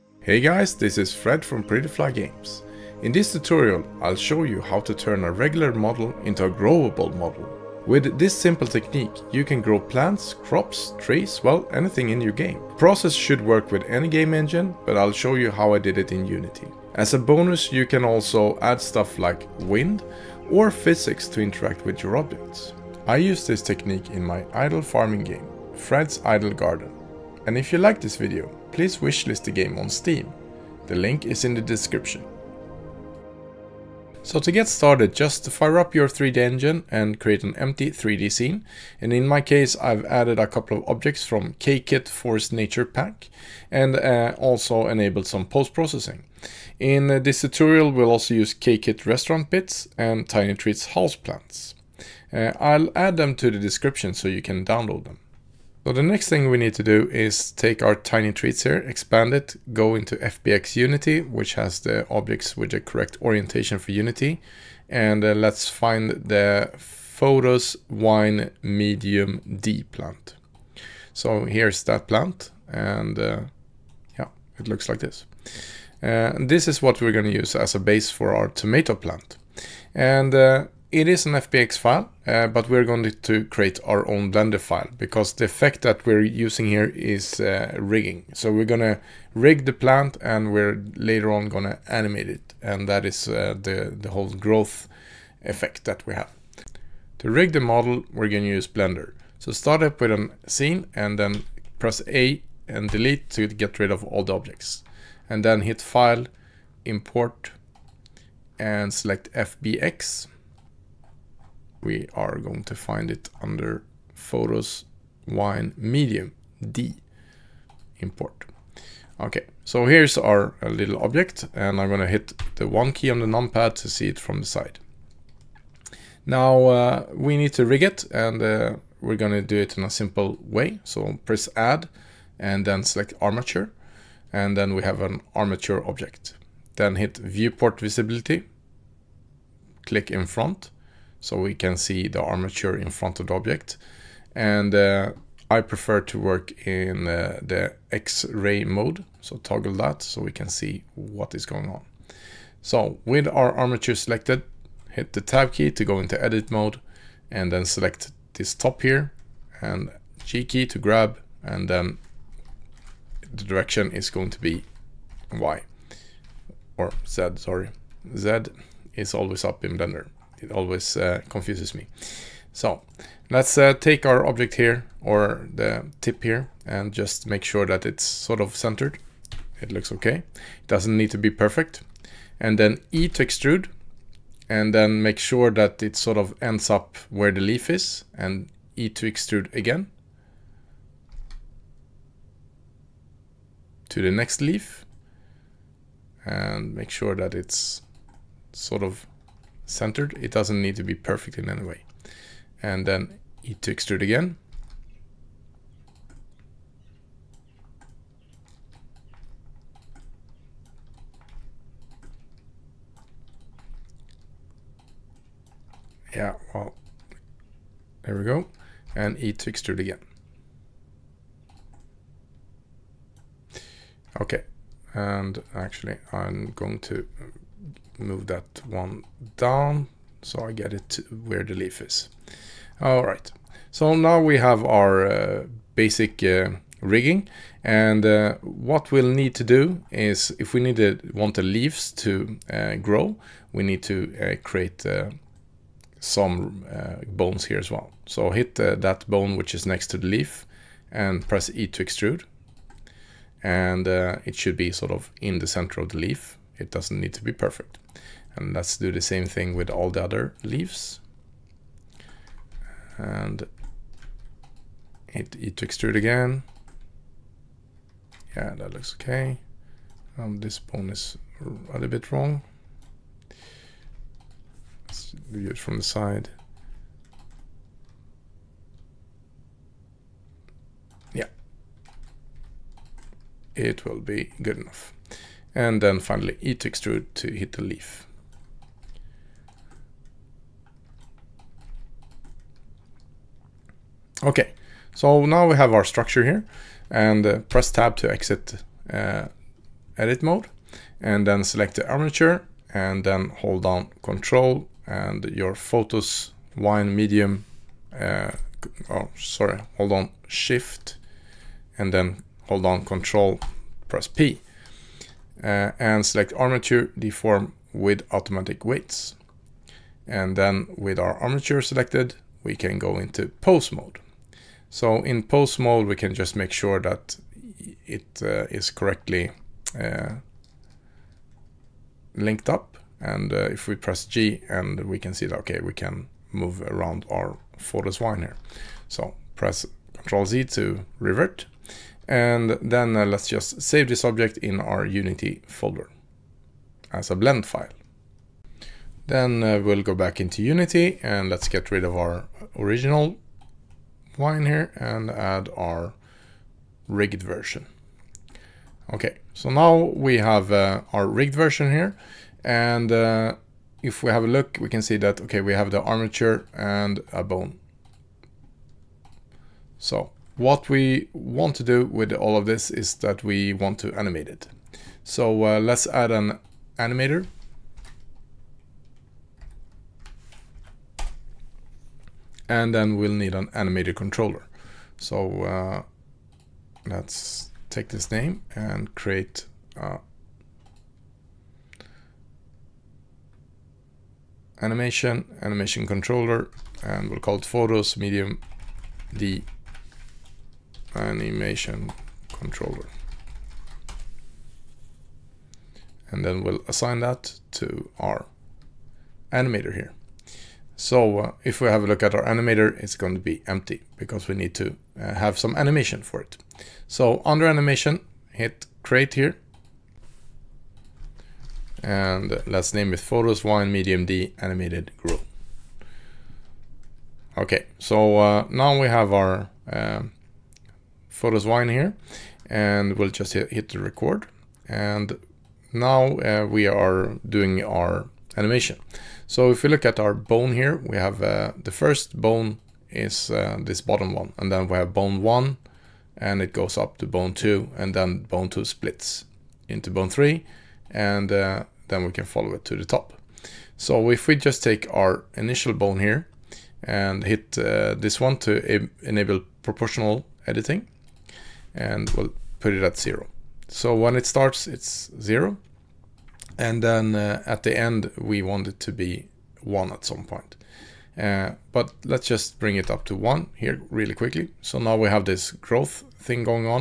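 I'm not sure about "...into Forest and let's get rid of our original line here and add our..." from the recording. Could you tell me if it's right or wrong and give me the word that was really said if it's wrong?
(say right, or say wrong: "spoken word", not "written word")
wrong: "Unity", not "Forest".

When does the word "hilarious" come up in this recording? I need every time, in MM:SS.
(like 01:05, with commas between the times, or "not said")
not said.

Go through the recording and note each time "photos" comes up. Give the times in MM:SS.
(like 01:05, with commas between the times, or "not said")
01:06, 01:54, 05:05, 05:37, 06:37, 07:02, 07:11.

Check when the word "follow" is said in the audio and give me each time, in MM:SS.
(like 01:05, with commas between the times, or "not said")
07:32.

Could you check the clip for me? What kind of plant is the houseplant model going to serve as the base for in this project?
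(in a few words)
tomato plant.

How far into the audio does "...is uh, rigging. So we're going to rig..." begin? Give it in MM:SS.
01:26.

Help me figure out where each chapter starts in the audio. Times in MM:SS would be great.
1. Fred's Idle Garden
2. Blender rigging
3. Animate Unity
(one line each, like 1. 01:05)
1. 00:23
2. 01:37
3. 05:55.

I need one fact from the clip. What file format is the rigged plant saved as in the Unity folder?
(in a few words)
blend file.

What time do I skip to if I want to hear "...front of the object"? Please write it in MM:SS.
02:22.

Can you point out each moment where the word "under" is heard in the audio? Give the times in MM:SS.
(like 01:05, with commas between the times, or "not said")
01:53, 06:57.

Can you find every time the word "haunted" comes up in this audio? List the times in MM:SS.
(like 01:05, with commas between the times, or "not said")
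not said.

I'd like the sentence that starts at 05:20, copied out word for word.
And then with our armature selected, we can go into pose mode.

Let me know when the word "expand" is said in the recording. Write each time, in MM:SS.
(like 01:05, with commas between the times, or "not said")
00:58.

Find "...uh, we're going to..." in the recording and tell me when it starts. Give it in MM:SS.
02:08.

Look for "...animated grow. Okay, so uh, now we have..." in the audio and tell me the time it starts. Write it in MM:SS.
07:04.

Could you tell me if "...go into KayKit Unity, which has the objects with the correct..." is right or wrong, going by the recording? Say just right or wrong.
wrong.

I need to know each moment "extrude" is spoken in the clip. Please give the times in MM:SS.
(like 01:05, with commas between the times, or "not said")
03:03, 03:09, 03:23, 03:39, 04:11, 04:25, 04:46.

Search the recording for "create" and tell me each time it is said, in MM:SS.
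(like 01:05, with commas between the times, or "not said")
00:37, 01:23, 04:04, 06:28, 06:58.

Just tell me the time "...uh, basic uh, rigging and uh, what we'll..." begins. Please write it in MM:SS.
03:55.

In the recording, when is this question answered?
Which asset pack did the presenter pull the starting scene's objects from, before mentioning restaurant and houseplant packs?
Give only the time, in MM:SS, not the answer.
00:41.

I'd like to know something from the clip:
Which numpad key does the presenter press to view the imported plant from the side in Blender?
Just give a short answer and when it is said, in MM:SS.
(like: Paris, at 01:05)
1, at 02:02.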